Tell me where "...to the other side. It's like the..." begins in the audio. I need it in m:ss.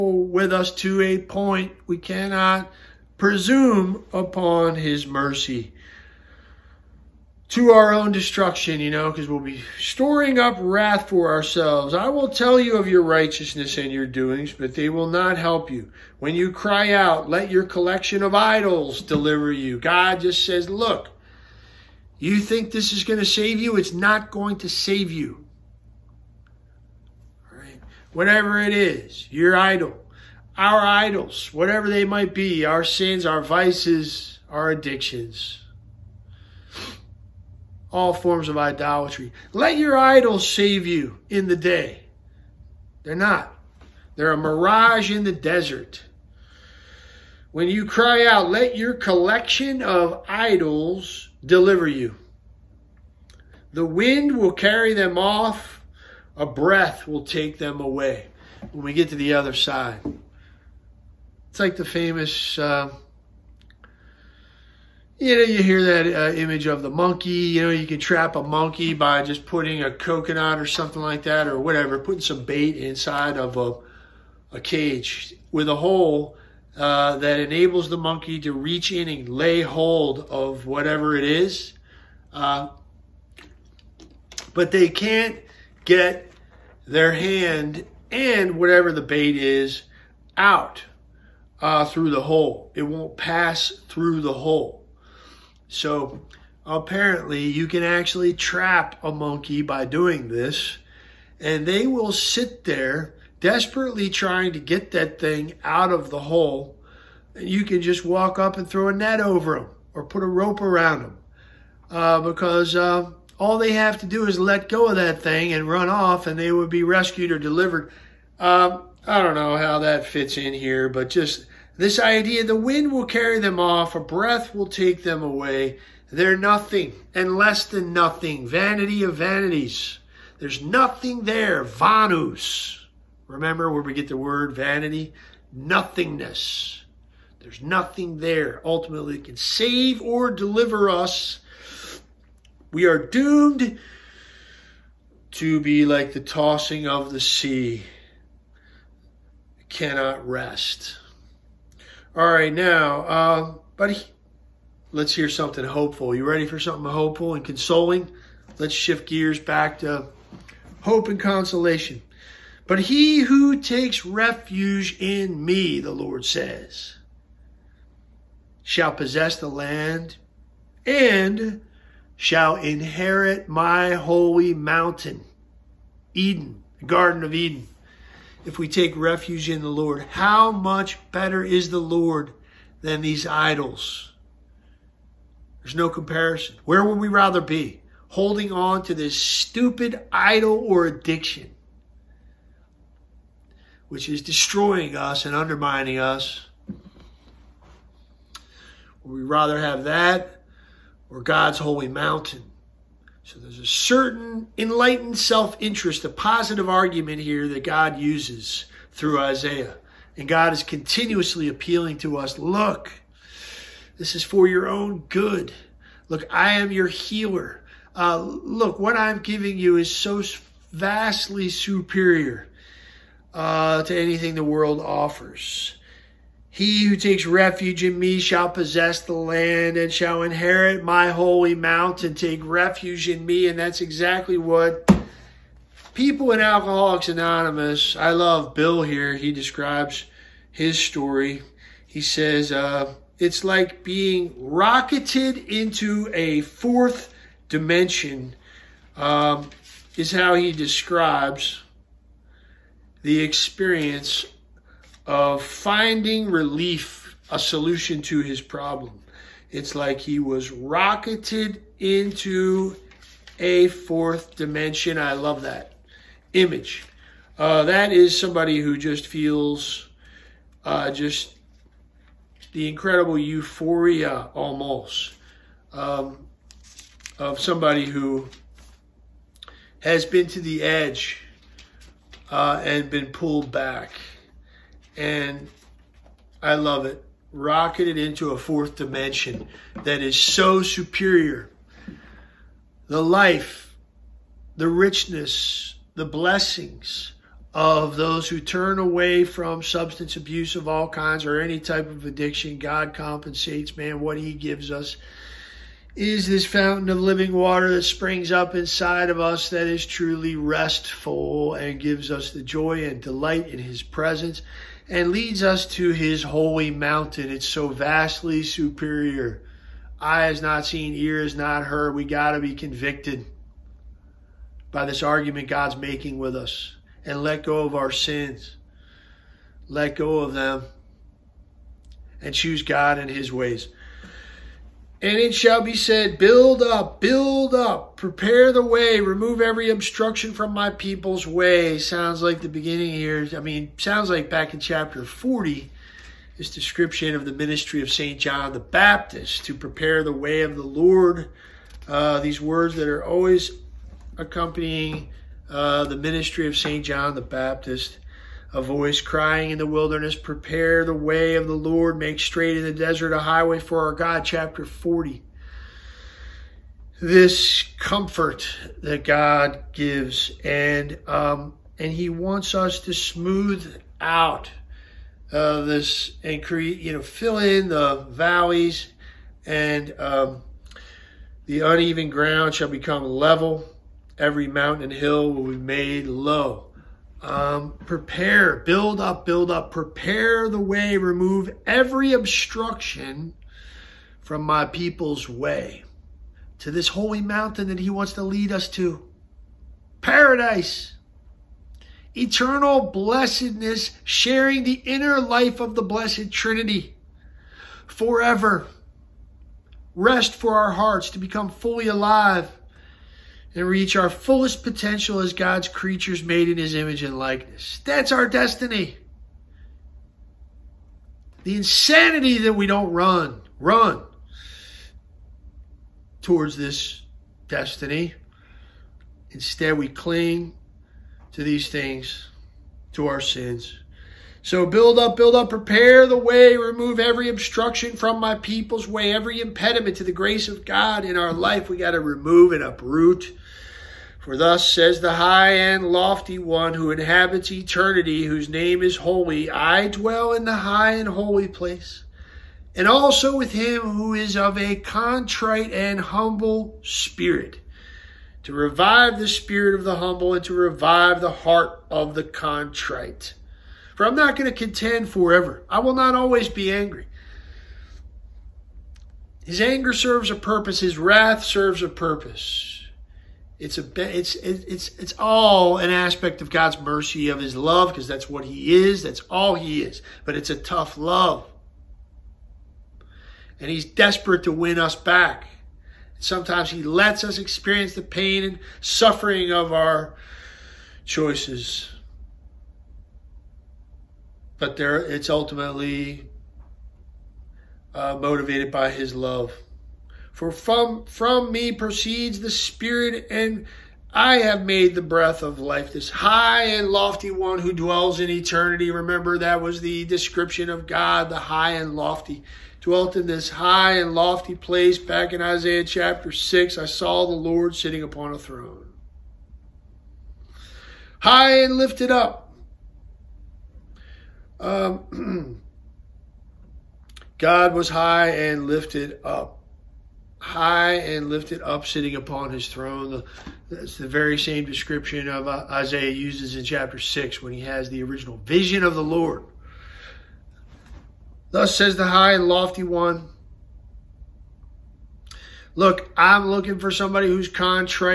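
0:59.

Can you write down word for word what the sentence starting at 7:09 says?
Instead, we cling to these things, to our sins.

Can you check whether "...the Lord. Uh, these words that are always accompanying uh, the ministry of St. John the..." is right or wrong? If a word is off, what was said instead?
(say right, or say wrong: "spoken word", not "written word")
right.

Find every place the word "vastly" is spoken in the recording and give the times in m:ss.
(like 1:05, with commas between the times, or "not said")
3:40, 5:17.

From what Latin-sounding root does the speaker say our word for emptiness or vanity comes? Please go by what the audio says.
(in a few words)
Vanus.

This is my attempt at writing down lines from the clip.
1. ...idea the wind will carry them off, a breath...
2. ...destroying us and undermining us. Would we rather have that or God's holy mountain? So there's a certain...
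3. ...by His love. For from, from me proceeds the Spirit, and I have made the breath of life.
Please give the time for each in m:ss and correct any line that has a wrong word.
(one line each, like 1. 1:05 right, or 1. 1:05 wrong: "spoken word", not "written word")
1. 2:01 right
2. 3:14 right
3. 8:18 right.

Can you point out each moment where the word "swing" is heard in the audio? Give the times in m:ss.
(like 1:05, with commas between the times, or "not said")
not said.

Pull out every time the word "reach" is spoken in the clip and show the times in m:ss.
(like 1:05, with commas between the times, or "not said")
1:18, 6:53.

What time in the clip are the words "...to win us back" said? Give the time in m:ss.
8:04.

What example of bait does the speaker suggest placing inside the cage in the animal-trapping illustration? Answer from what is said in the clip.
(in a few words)
A coconut.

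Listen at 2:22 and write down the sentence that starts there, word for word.
We are doomed to be like the tossing of the sea cannot rest.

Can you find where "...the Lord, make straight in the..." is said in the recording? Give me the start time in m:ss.
6:01.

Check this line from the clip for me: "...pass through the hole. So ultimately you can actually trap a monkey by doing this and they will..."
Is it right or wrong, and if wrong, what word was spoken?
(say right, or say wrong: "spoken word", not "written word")
wrong: "apparently", not "ultimately".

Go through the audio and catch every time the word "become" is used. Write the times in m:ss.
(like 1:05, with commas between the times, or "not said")
6:22, 6:51.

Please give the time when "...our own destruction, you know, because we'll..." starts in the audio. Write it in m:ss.
0:07.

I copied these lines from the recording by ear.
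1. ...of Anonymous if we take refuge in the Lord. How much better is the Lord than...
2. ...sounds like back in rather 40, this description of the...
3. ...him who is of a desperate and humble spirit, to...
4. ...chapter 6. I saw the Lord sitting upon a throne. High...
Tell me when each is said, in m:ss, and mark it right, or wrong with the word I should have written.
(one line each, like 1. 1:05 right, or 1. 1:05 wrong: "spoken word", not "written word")
1. 2:57 wrong: "Eden", not "Anonymous"
2. 5:43 wrong: "chapter", not "rather"
3. 7:33 wrong: "contrite", not "desperate"
4. 8:35 right.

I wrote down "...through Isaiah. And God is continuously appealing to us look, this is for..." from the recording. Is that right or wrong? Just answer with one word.
right.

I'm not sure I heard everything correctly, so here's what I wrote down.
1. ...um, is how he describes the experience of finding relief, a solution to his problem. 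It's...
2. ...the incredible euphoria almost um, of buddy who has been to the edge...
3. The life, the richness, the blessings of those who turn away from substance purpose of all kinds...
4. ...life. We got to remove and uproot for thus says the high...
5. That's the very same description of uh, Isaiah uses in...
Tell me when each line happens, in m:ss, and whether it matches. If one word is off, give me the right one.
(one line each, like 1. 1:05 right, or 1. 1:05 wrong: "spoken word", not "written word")
1. 4:08 right
2. 4:32 wrong: "somebody", not "buddy"
3. 4:52 wrong: "abuse", not "purpose"
4. 7:21 right
5. 8:53 right.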